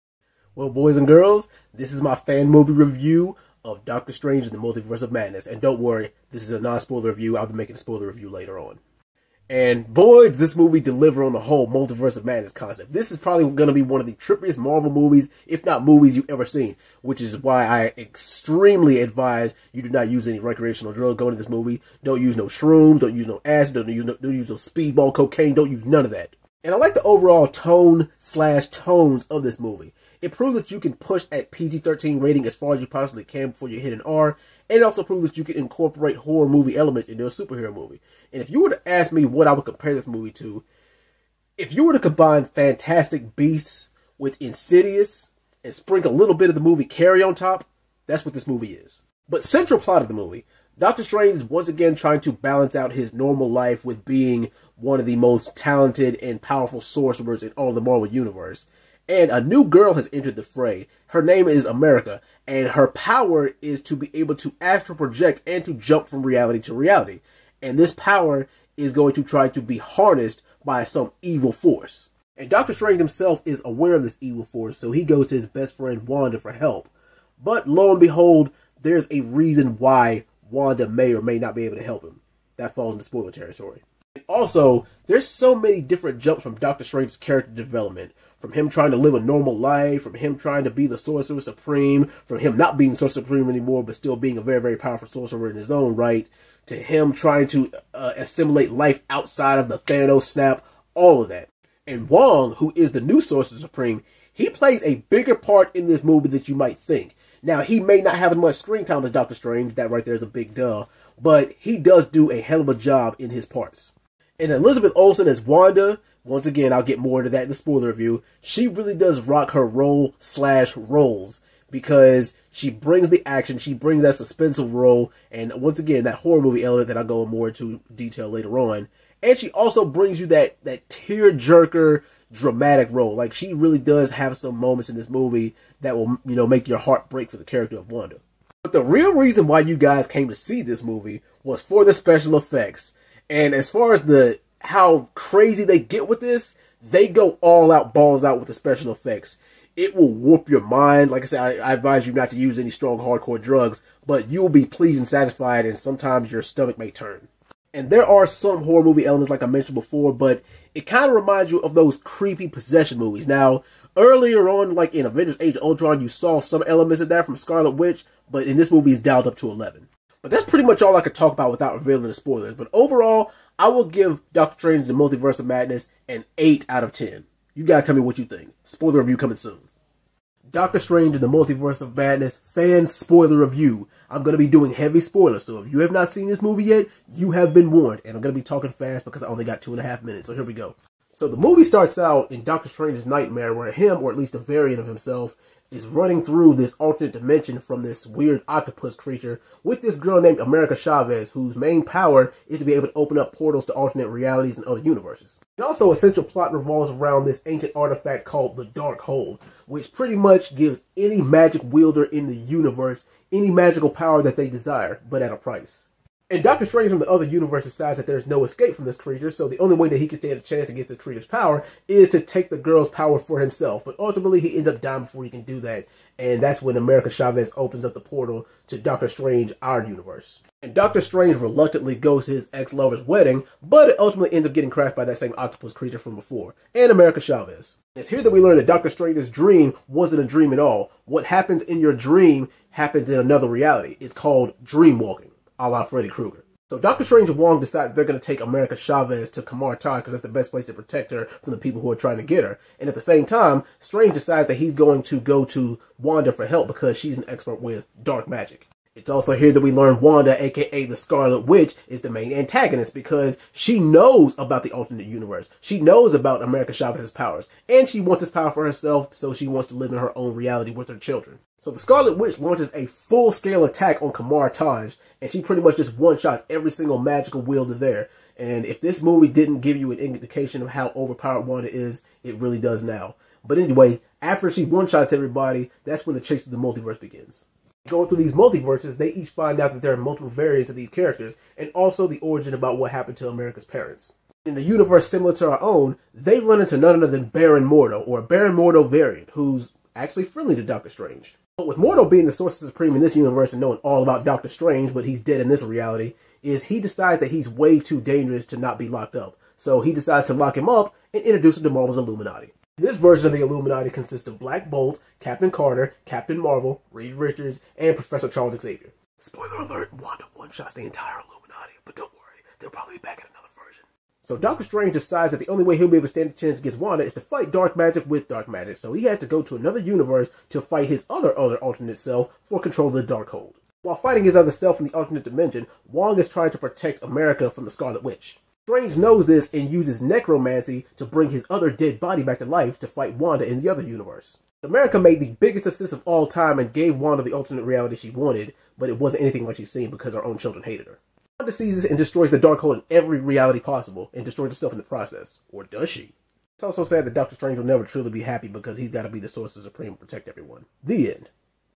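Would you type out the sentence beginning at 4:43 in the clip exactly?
But anyway, after she one-shots everybody, that's when the chase of the multiverse begins.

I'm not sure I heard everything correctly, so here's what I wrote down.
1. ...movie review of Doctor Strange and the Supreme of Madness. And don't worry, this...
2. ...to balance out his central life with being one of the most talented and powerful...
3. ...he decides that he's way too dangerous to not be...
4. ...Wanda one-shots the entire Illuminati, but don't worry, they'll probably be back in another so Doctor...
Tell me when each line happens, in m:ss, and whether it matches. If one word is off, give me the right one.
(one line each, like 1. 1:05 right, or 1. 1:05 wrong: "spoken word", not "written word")
1. 0:02 wrong: "Multiverse", not "Supreme"
2. 0:52 wrong: "normal", not "central"
3. 5:06 right
4. 5:19 right.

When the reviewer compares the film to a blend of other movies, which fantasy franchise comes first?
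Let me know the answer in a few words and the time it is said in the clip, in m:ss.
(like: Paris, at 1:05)
Fantastic Beasts, at 0:42.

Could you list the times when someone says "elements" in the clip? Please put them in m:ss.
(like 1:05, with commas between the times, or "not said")
0:36, 2:06, 2:39, 2:46.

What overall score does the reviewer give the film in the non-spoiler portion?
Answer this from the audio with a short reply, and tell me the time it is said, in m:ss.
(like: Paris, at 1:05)
8 out of 10, at 2:56.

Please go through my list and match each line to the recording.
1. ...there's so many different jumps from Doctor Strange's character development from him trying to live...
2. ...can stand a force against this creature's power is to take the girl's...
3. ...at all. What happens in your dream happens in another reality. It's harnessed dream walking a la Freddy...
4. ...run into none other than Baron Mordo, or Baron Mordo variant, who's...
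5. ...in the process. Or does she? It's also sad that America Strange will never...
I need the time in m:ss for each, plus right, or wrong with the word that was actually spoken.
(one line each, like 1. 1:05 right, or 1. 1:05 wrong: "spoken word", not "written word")
1. 1:25 right
2. 3:40 wrong: "chance", not "force"
3. 4:00 wrong: "called", not "harnessed"
4. 4:56 right
5. 5:54 wrong: "Doctor", not "America".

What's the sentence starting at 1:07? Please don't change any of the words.
And this power is going to try to be harnessed by some evil force.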